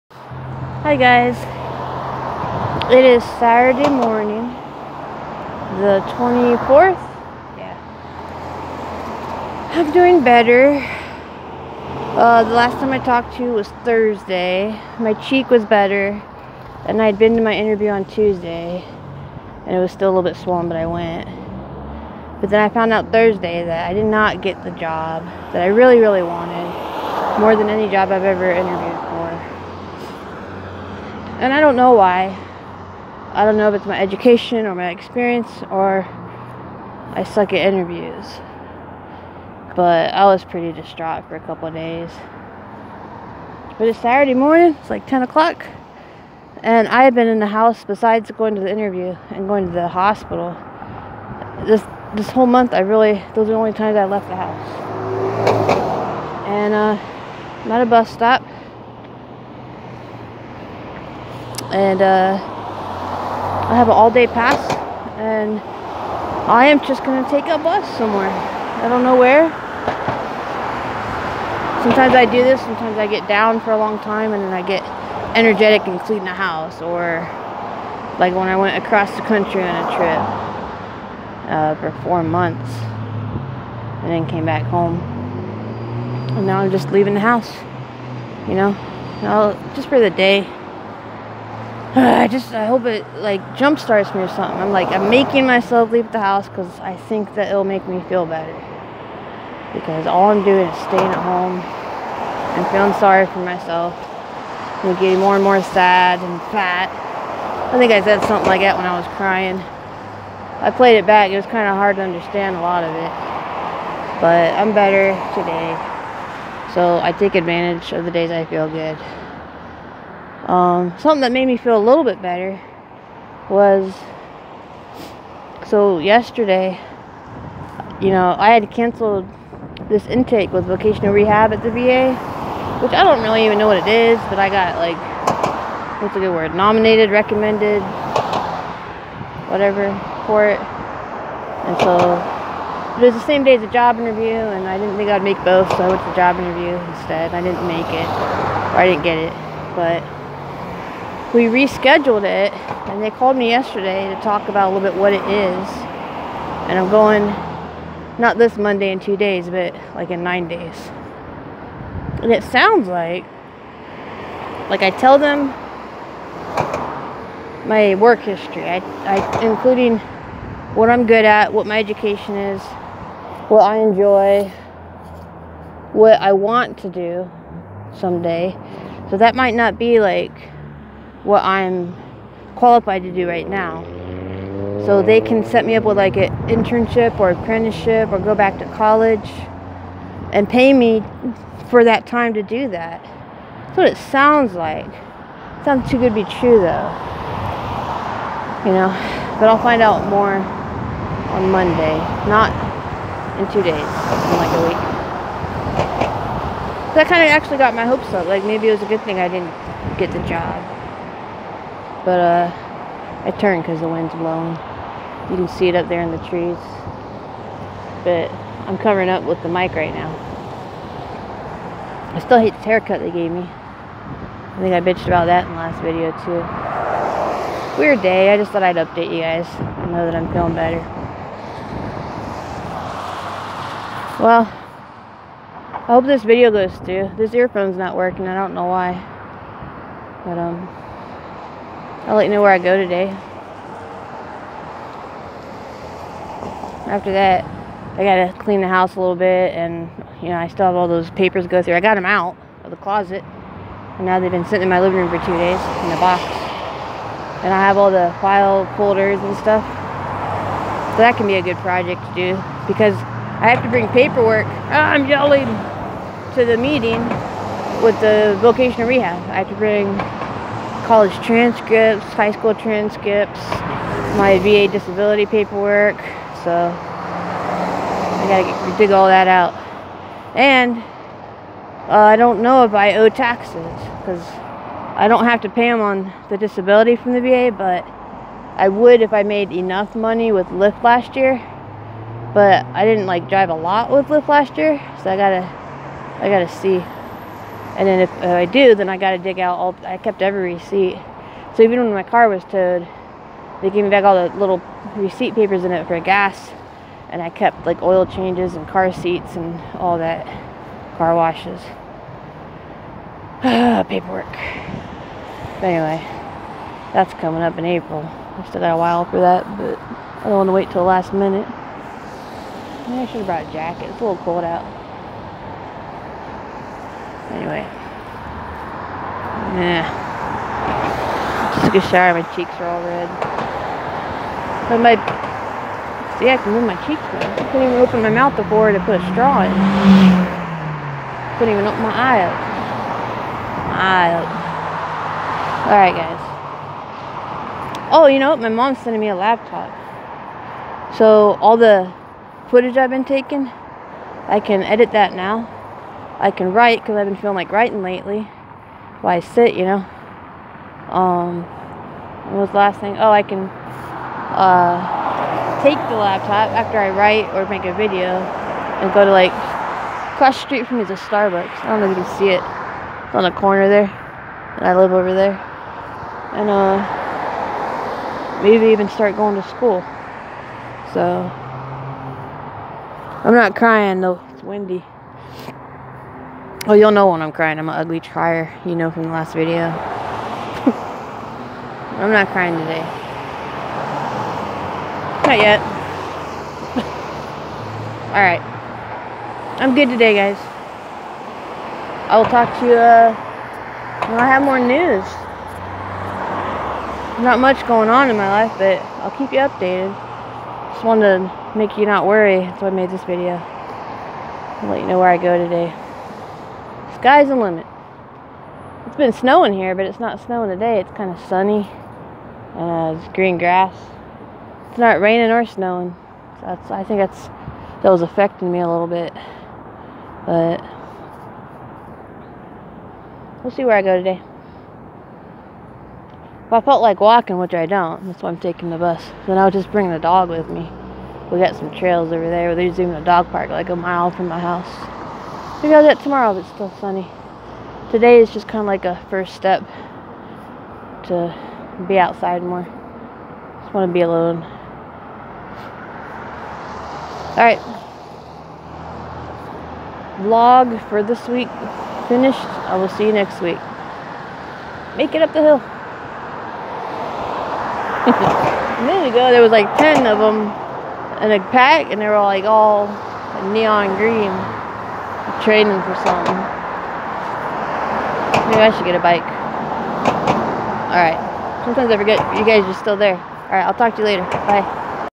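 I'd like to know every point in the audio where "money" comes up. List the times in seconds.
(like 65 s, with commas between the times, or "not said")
289 s.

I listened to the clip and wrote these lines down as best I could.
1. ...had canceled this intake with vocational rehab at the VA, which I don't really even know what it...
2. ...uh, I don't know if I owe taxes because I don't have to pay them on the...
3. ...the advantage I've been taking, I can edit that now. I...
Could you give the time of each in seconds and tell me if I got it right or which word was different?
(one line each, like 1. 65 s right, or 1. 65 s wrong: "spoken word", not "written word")
1. 128 s right
2. 281 s right
3. 351 s wrong: "footage", not "advantage".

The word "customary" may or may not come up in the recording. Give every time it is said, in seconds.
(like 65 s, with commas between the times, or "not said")
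not said.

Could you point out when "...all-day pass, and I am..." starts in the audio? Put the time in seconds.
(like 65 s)
63 s.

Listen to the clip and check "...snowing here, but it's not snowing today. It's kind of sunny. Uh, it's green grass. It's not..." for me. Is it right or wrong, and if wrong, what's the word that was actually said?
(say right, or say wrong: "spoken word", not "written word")
right.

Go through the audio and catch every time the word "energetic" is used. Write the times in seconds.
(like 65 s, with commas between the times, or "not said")
75 s.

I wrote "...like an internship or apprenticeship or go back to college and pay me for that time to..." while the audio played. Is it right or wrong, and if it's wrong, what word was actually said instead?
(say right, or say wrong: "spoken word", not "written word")
right.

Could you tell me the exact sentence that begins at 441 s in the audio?
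We got some trails over there.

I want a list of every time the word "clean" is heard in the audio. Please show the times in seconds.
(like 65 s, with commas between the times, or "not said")
76 s, 248 s.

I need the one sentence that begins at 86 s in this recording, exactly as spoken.
And now I'm just leaving the house, you know?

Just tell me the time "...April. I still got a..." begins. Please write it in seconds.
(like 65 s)
317 s.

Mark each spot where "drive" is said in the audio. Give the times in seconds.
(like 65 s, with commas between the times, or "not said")
293 s.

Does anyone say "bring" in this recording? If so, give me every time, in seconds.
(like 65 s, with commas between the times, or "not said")
263 s, 269 s, 439 s.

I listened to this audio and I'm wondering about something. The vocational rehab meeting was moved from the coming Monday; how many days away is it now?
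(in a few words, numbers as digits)
9.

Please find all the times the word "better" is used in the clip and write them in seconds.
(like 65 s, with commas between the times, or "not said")
10 s, 15 s, 98 s, 114 s, 122 s, 230 s.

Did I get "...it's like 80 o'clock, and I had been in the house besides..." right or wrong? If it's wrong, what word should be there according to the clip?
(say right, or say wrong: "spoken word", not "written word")
wrong: "10", not "80".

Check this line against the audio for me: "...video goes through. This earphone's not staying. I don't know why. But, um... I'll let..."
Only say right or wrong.
wrong.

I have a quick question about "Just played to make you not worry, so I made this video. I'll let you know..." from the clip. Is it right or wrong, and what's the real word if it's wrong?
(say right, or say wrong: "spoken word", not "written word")
wrong: "wanted", not "played".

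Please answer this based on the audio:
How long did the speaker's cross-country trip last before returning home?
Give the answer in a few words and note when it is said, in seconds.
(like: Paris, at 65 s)
4 months, at 82 s.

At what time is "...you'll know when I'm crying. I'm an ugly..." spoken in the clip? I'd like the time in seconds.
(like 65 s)
386 s.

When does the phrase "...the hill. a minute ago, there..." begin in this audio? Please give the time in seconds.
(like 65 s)
465 s.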